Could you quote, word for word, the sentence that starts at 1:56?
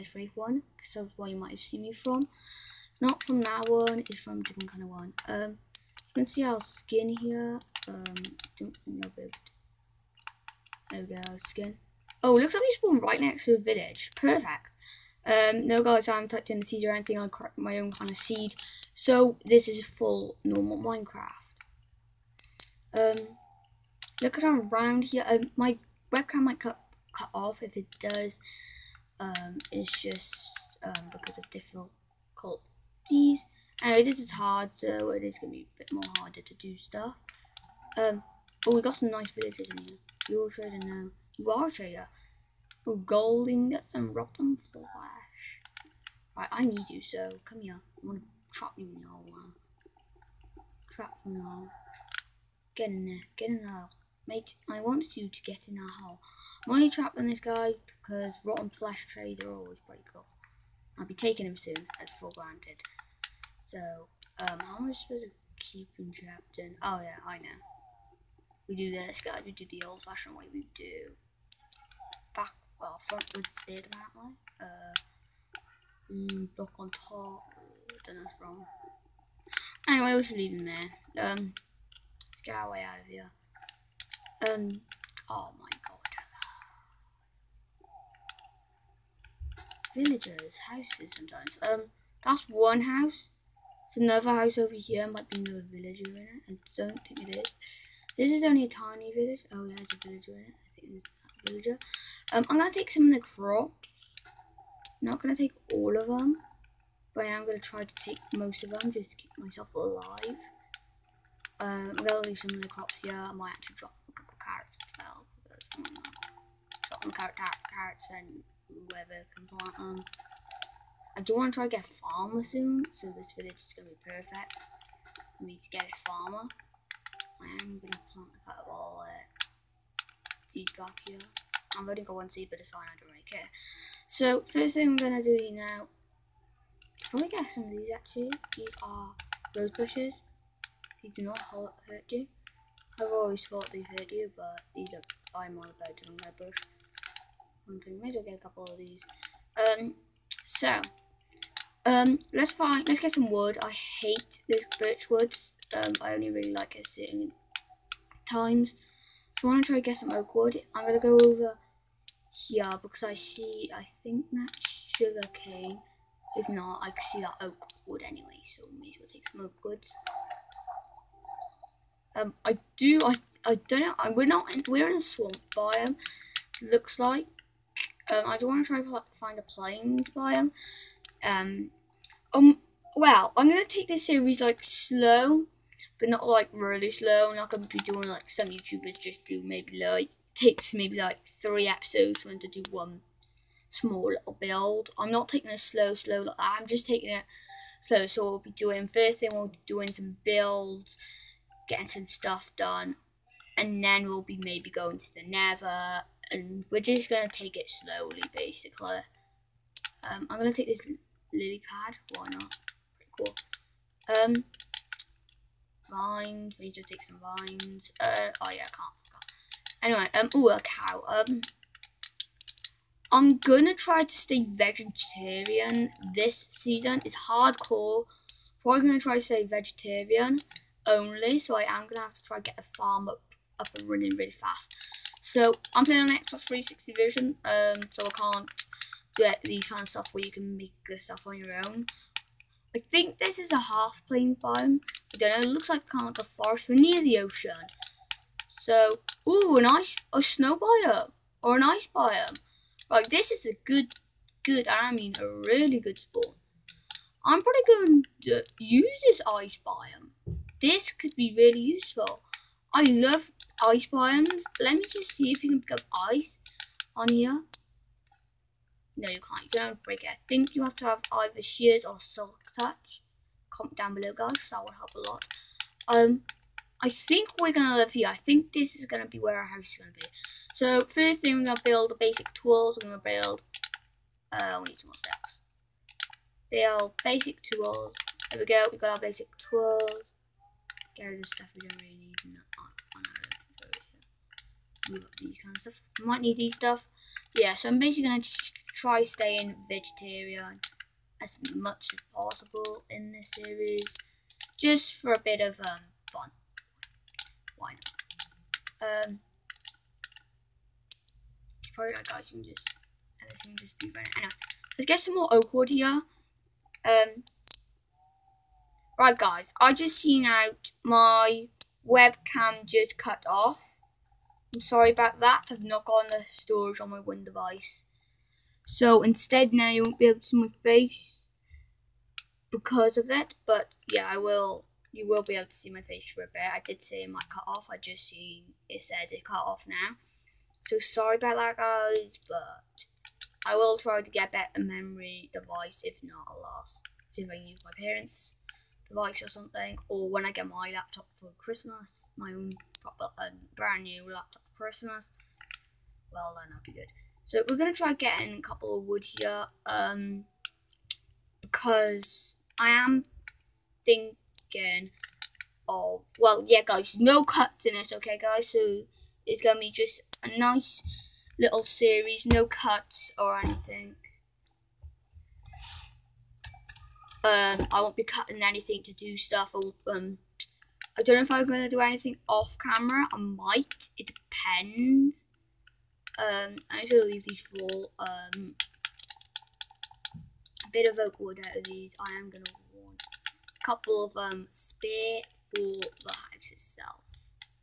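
Drop some carrot, carrot, carrots and whoever can plant them.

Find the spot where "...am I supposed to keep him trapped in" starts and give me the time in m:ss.
1:04.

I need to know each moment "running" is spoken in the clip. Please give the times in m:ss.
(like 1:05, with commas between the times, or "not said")
3:53, 5:13.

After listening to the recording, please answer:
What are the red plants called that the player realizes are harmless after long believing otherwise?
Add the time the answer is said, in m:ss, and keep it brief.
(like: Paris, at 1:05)
Rose bushes, at 2:19.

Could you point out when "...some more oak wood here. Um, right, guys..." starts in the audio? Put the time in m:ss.
5:14.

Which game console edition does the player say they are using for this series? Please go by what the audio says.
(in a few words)
Xbox 360.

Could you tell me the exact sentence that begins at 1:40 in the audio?
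I think um, I'm going to take some of the crops.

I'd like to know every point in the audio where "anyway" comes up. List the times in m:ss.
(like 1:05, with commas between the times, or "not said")
0:33, 1:19, 2:48, 3:39, 5:14.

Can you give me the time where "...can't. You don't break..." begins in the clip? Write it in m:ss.
4:29.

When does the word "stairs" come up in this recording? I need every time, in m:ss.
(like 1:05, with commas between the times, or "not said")
1:13.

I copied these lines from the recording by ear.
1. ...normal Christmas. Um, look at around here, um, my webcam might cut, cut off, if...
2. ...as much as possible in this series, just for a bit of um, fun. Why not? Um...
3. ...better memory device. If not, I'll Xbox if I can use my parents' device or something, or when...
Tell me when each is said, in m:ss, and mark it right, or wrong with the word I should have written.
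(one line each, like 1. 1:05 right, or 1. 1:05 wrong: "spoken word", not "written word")
1. 0:20 wrong: "Minecraft", not "Christmas"
2. 5:01 right
3. 5:44 wrong: "See", not "Xbox".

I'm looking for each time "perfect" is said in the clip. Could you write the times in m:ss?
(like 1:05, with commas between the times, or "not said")
0:14, 2:04.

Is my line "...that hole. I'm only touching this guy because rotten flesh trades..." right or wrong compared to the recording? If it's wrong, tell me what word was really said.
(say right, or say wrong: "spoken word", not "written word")
wrong: "trapping", not "touching".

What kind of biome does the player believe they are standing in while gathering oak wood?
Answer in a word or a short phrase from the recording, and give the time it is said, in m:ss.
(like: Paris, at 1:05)
Swamp, at 2:55.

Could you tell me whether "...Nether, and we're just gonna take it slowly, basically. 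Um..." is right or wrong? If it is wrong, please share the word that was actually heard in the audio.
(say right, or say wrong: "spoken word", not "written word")
right.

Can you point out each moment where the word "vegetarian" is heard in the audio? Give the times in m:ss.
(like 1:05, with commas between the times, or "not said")
3:44, 3:49, 4:59.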